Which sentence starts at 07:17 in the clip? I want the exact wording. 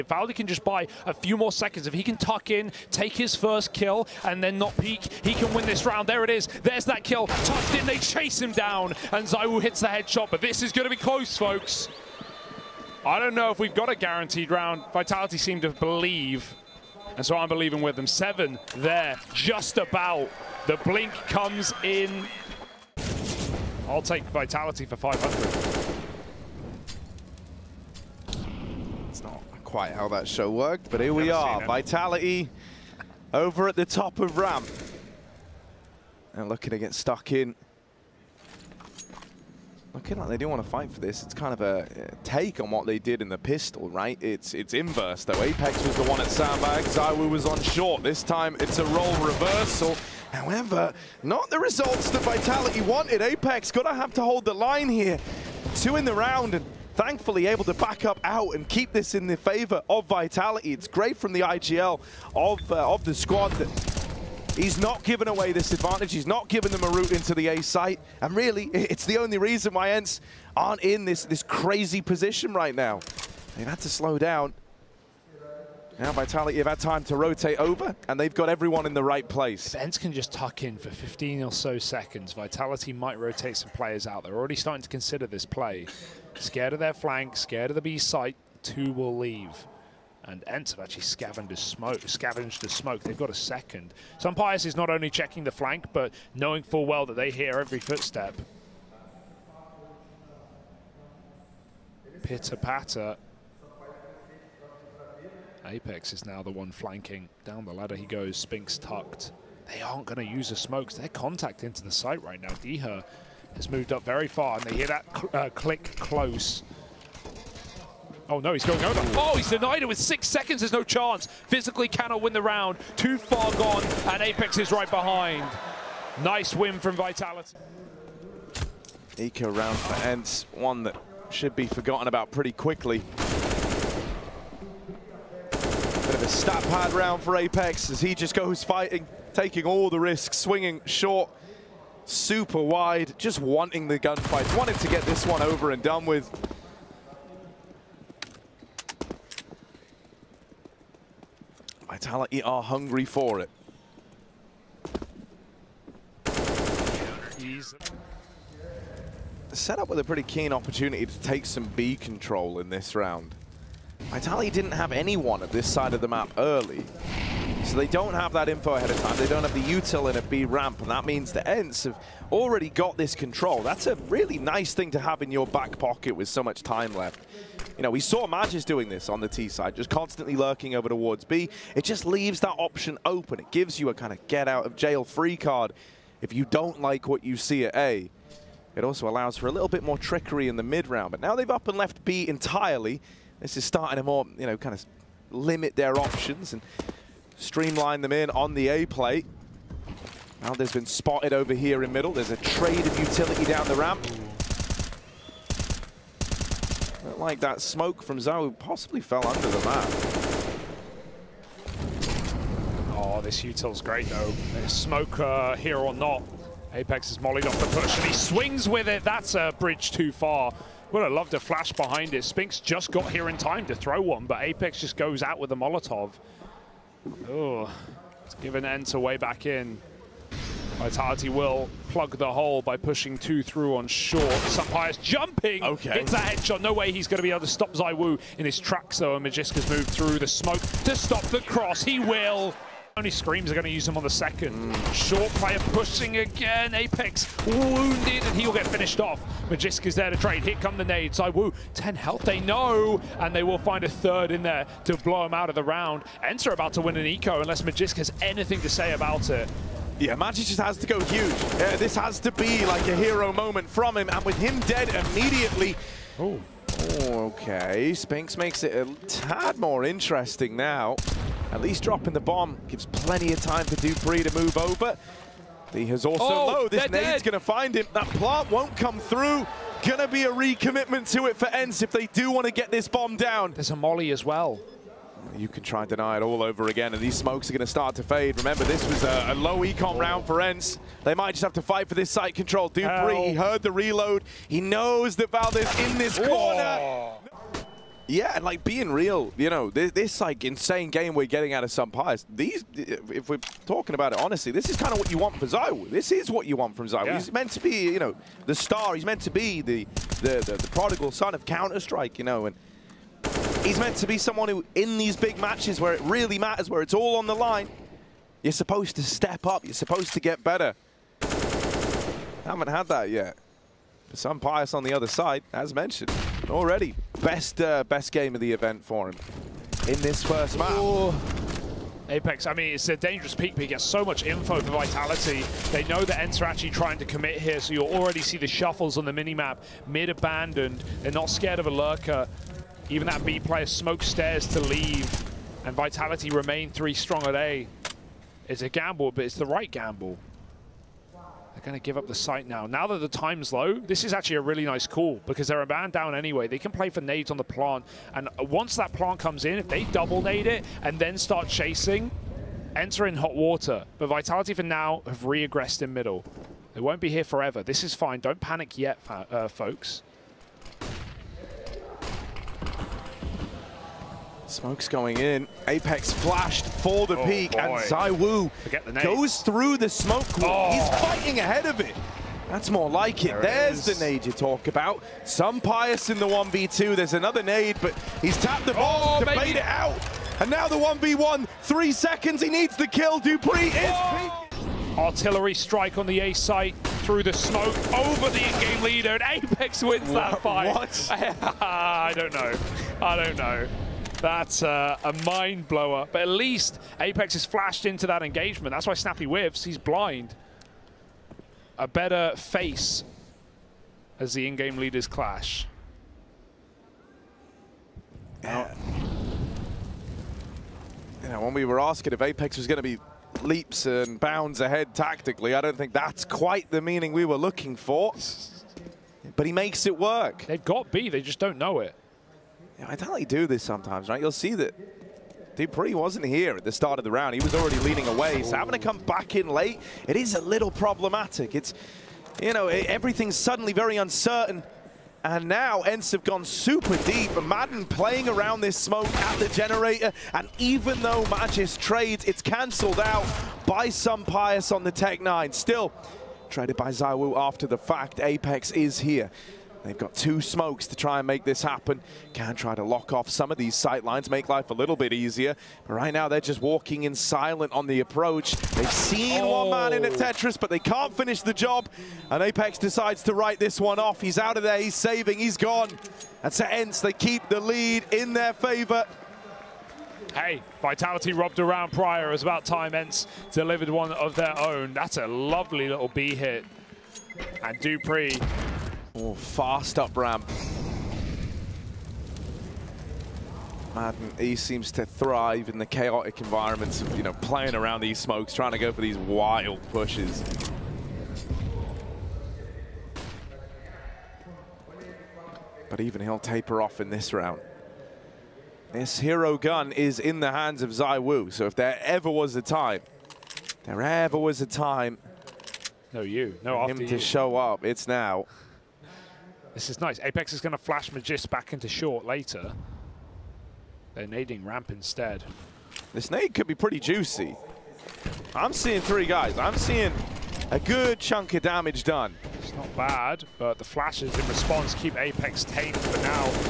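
He was already leaning away, so having to come back in late, it is a little problematic.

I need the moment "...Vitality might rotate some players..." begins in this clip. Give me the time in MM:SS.
01:22.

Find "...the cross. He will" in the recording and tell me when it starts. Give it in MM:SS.
04:01.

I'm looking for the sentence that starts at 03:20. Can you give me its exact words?
Now there's been spotted over here in middle.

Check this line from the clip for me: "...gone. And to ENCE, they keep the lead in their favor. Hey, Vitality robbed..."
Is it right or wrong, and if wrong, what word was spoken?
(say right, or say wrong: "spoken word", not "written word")
right.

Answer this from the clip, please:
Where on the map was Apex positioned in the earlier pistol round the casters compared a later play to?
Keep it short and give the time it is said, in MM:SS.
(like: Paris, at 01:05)
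Sandbag, at 00:46.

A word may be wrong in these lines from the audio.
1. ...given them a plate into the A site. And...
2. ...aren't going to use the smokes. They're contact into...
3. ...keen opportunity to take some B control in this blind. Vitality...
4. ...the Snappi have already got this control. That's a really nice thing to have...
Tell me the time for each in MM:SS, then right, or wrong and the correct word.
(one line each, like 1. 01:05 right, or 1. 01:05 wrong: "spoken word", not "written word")
1. 01:06 wrong: "route", not "plate"
2. 01:49 right
3. 02:40 wrong: "round", not "blind"
4. 02:51 wrong: "ENCE", not "Snappi".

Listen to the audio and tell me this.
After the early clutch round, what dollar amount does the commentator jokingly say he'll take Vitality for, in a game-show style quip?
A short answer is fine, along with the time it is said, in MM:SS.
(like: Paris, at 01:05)
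500, at 00:24.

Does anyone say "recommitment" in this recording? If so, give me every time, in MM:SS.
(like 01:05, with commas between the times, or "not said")
04:40.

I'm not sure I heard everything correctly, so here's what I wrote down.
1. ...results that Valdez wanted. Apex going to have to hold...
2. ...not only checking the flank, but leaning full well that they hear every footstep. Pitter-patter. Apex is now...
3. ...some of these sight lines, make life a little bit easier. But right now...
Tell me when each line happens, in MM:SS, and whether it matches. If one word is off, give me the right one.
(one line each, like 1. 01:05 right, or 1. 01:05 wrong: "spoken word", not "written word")
1. 00:51 wrong: "Vitality", not "Valdez"
2. 01:34 wrong: "knowing", not "leaning"
3. 07:43 right.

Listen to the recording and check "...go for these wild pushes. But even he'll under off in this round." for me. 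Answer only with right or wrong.
wrong.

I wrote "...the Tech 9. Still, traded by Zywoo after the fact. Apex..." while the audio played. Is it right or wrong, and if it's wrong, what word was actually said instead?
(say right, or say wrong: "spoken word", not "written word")
right.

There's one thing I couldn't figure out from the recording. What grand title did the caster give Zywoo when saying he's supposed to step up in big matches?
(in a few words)
prodigal son of Counter Strike.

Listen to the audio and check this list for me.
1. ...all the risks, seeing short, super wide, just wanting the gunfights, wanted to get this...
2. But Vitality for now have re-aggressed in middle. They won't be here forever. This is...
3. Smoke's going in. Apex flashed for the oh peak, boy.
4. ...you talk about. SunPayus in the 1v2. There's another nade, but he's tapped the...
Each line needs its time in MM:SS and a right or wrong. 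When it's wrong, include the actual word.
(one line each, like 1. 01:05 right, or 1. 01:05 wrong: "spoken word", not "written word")
1. 02:19 wrong: "swinging", not "seeing"
2. 06:03 right
3. 06:14 right
4. 06:24 right.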